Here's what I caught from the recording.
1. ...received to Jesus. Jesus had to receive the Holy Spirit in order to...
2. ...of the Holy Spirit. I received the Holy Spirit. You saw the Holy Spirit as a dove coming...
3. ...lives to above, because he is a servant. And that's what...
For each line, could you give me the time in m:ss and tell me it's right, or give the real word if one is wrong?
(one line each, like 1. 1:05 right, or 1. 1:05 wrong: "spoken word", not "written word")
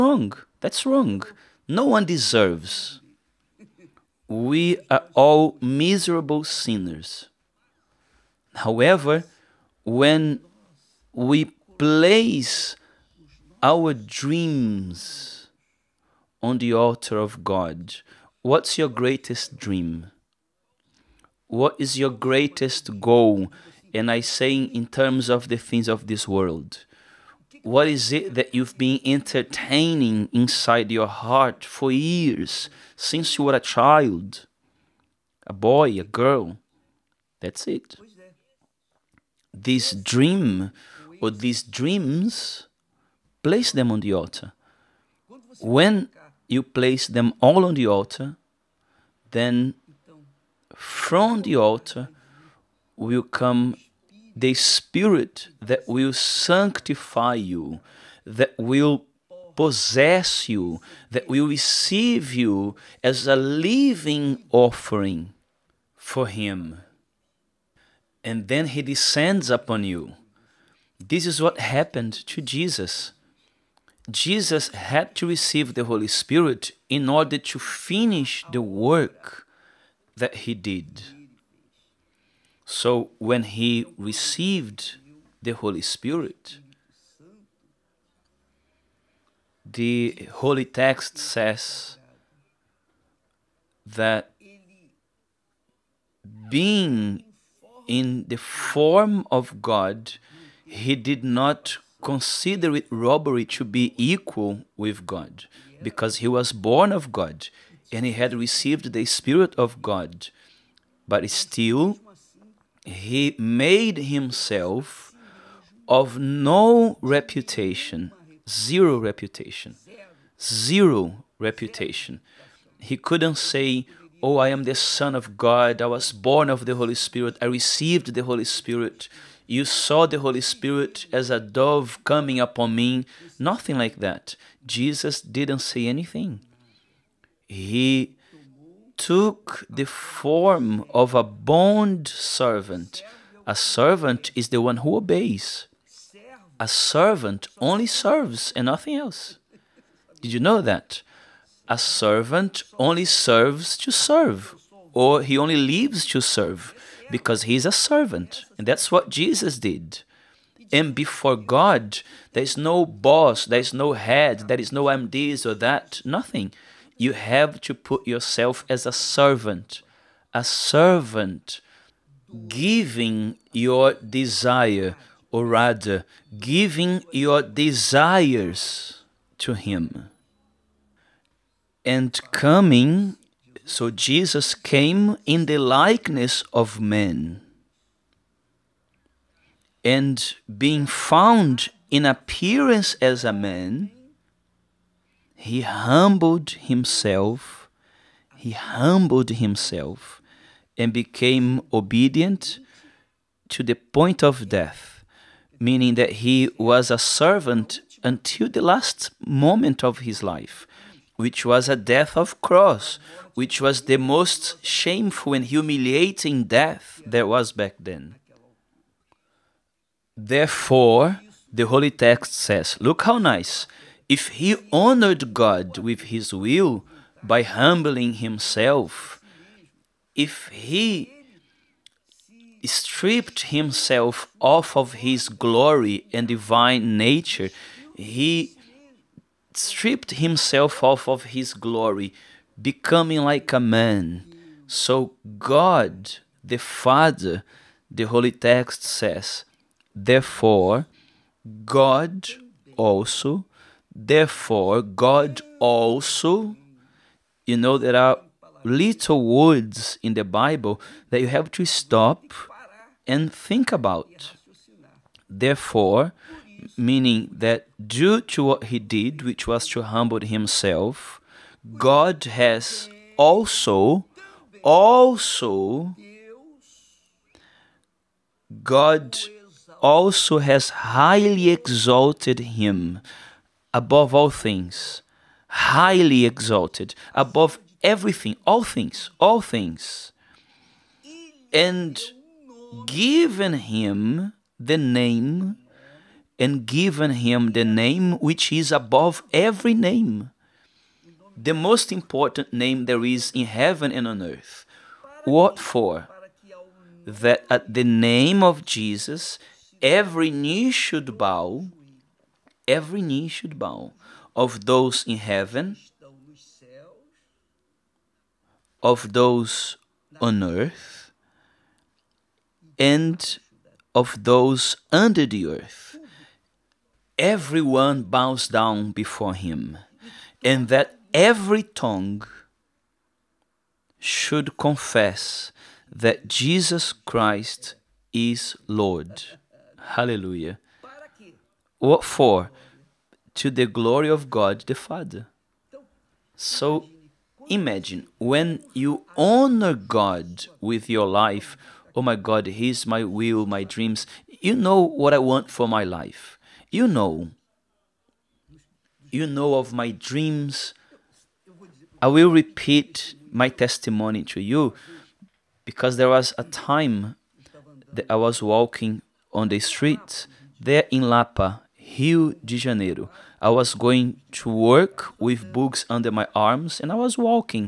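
1. 1:11 wrong: "happened", not "received"
2. 2:06 right
3. 2:35 wrong: "serve", not "above".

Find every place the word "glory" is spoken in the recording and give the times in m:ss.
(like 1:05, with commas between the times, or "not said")
3:55, 4:01, 5:43.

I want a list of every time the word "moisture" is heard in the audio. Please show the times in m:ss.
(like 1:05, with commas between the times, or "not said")
not said.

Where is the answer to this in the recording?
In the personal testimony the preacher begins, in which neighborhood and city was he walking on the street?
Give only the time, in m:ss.
6:11.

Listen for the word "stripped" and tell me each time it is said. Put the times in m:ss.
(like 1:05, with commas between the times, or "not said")
3:52, 3:59.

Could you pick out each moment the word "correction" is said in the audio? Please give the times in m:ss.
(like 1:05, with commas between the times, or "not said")
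not said.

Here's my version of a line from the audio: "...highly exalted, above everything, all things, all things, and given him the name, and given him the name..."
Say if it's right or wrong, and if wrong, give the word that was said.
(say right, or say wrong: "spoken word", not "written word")
right.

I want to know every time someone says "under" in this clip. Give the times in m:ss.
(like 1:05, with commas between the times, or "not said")
5:24, 6:15.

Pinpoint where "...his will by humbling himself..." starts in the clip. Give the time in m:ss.
3:46.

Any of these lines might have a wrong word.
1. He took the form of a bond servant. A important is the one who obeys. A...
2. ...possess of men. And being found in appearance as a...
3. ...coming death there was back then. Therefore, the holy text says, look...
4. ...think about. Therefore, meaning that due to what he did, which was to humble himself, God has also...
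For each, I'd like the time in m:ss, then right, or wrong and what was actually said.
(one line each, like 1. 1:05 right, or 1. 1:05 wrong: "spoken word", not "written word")
1. 2:17 wrong: "servant", not "important"
2. 3:05 wrong: "likeness", not "possess"
3. 3:35 wrong: "humiliating", not "coming"
4. 4:23 right.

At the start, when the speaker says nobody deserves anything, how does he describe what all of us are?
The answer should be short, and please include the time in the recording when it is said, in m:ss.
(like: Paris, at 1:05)
miserable sinners, at 0:05.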